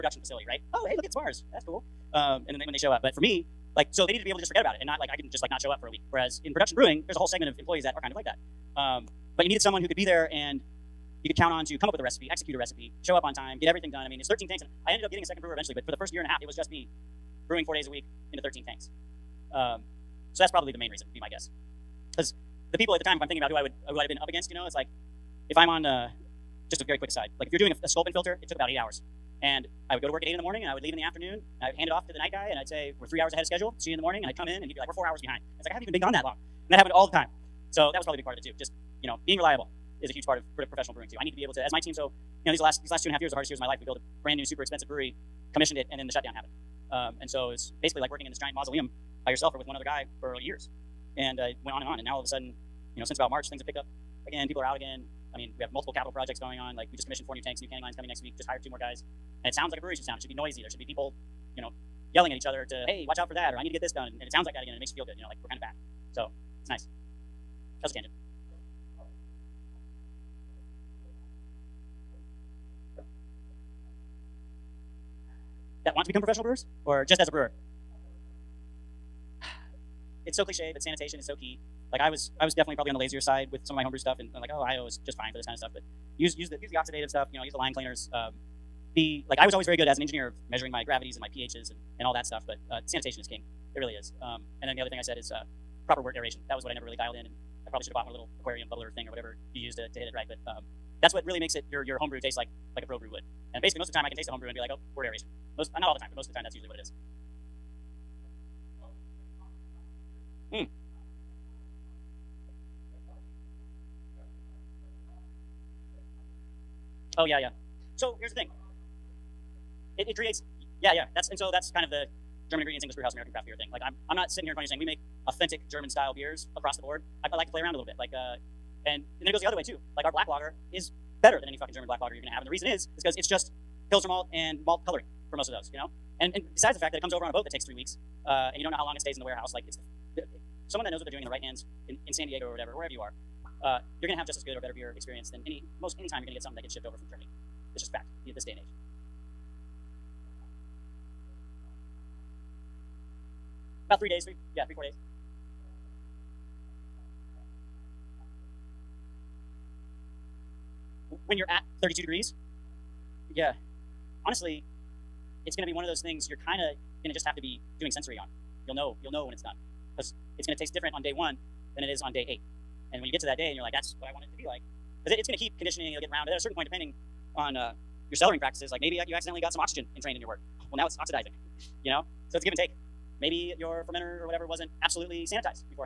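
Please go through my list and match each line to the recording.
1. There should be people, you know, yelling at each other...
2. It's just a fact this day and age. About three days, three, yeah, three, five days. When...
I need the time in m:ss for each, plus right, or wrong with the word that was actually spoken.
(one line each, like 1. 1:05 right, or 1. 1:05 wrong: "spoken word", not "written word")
1. 1:00 right
2. 2:27 wrong: "four", not "five".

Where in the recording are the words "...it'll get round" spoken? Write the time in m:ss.
2:55.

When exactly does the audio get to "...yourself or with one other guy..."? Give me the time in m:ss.
0:49.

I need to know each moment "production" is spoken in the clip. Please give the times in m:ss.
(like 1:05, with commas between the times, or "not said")
0:06.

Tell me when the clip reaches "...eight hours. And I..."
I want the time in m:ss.
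0:28.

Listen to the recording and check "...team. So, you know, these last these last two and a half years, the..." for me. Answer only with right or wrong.
right.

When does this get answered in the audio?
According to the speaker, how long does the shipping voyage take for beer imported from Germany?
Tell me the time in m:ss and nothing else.
2:17.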